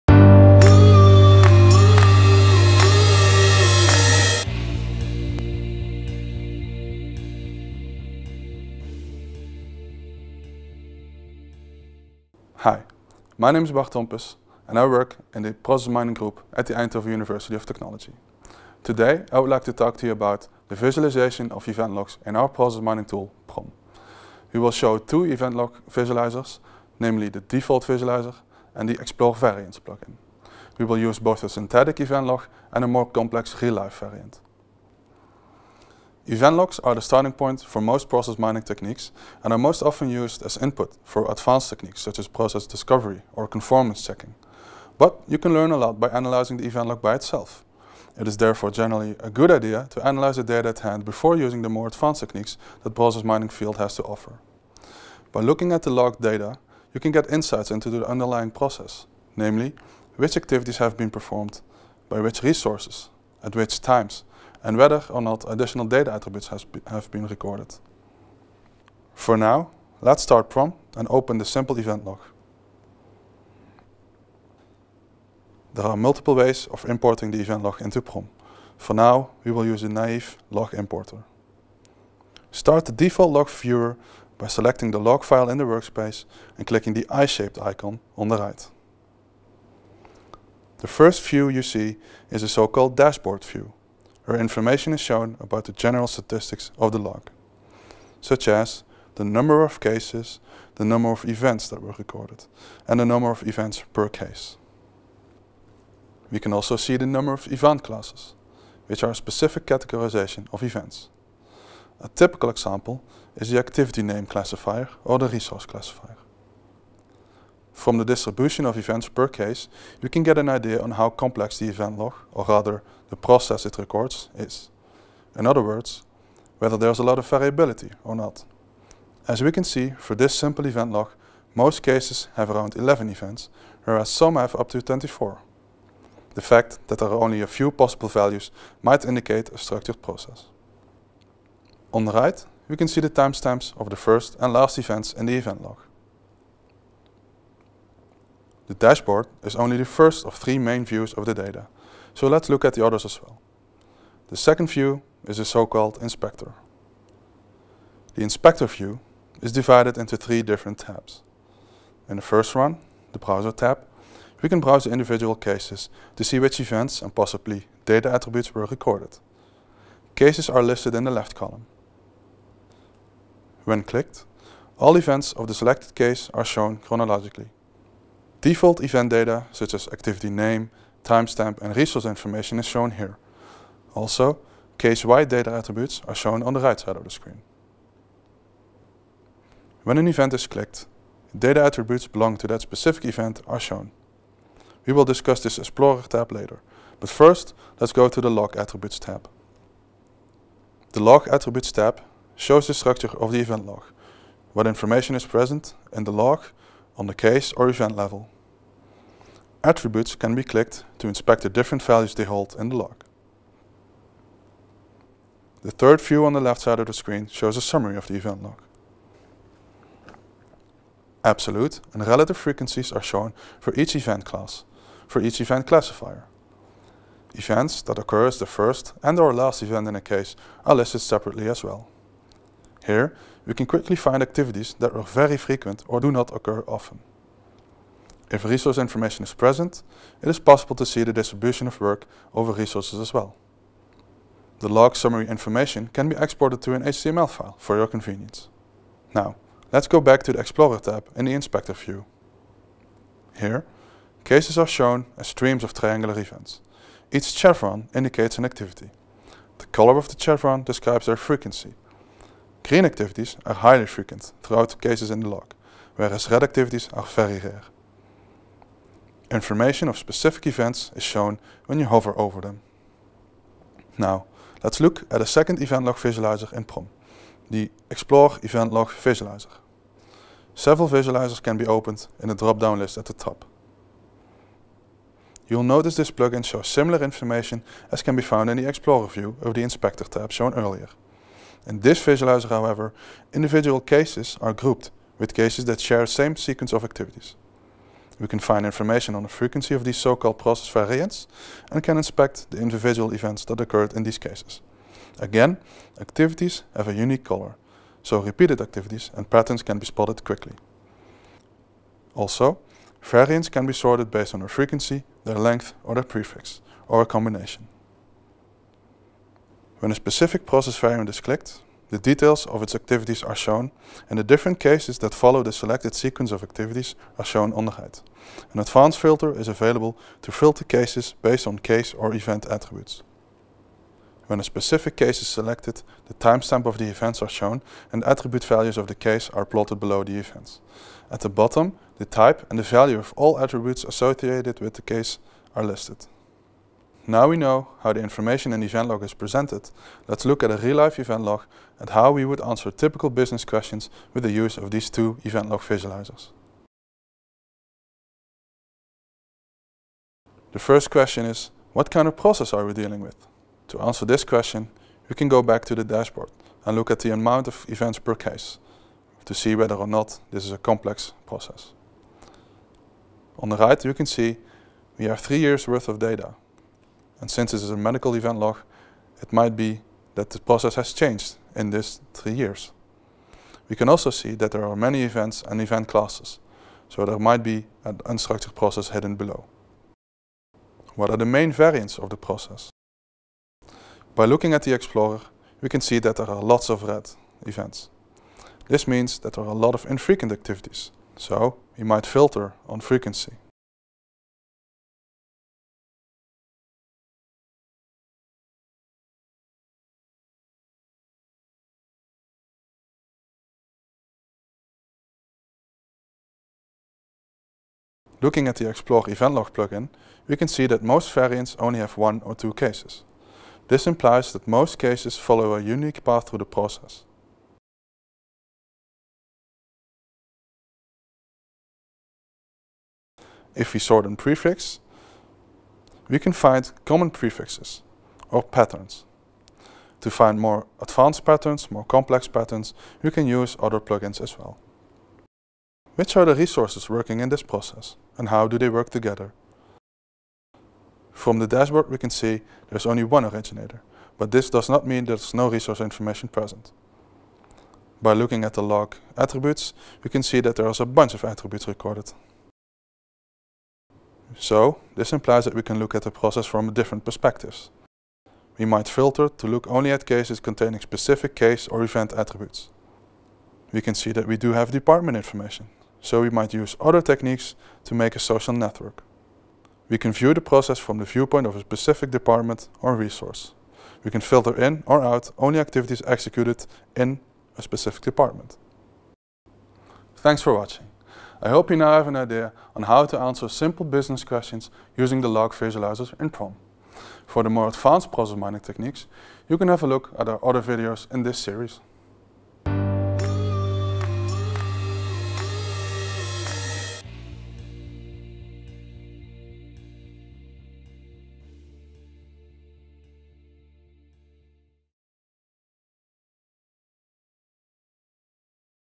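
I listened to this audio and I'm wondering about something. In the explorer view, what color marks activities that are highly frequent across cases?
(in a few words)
Green.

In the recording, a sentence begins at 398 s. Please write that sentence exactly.
This means that there are a lot of infrequent activities, so we might filter on frequency.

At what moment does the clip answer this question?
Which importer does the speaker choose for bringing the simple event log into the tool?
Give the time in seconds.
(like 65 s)
79 s.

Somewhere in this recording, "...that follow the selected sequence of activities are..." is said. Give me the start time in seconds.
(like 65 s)
324 s.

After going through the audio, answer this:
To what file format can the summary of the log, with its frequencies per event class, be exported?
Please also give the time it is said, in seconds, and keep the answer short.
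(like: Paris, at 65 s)
HTML, at 246 s.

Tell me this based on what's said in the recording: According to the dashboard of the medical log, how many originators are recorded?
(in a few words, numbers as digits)
1.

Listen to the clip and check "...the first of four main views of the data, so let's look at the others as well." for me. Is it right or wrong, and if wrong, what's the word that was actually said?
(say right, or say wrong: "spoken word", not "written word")
wrong: "three", not "four".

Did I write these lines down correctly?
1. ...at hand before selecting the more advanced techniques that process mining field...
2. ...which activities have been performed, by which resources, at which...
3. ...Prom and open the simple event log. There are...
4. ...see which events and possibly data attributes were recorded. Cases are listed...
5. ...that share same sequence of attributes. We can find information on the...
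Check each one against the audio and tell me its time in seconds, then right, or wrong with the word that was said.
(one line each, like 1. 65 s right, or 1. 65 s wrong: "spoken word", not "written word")
1. 50 s wrong: "using", not "selecting"
2. 60 s right
3. 70 s right
4. 166 s right
5. 295 s wrong: "activities", not "attributes".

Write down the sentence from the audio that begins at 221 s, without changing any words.
Absolute and relative frequencies are shown for each event class, for each event classifier.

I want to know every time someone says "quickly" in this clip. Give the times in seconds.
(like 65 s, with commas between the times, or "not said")
233 s, 310 s.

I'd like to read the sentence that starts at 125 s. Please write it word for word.
In other words, whether there's a lot of variability or not.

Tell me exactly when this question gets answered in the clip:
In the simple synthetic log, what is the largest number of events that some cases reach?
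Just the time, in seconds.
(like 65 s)
134 s.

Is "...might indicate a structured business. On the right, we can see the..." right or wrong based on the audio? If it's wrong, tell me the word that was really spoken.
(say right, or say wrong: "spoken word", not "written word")
wrong: "process", not "business".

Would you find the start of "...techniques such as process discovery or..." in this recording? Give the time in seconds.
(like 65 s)
41 s.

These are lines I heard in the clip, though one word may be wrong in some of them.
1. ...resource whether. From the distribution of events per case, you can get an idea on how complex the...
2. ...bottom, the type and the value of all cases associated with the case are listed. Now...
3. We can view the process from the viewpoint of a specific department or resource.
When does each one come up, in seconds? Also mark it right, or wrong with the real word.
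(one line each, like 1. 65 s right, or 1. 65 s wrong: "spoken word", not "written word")
1. 115 s wrong: "classifier", not "whether"
2. 341 s wrong: "attributes", not "cases"
3. 479 s right.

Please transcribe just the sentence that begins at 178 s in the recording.
Default event data, such as activity name, timestamp, and resource information is shown here.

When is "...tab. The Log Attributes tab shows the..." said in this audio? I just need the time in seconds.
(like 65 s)
198 s.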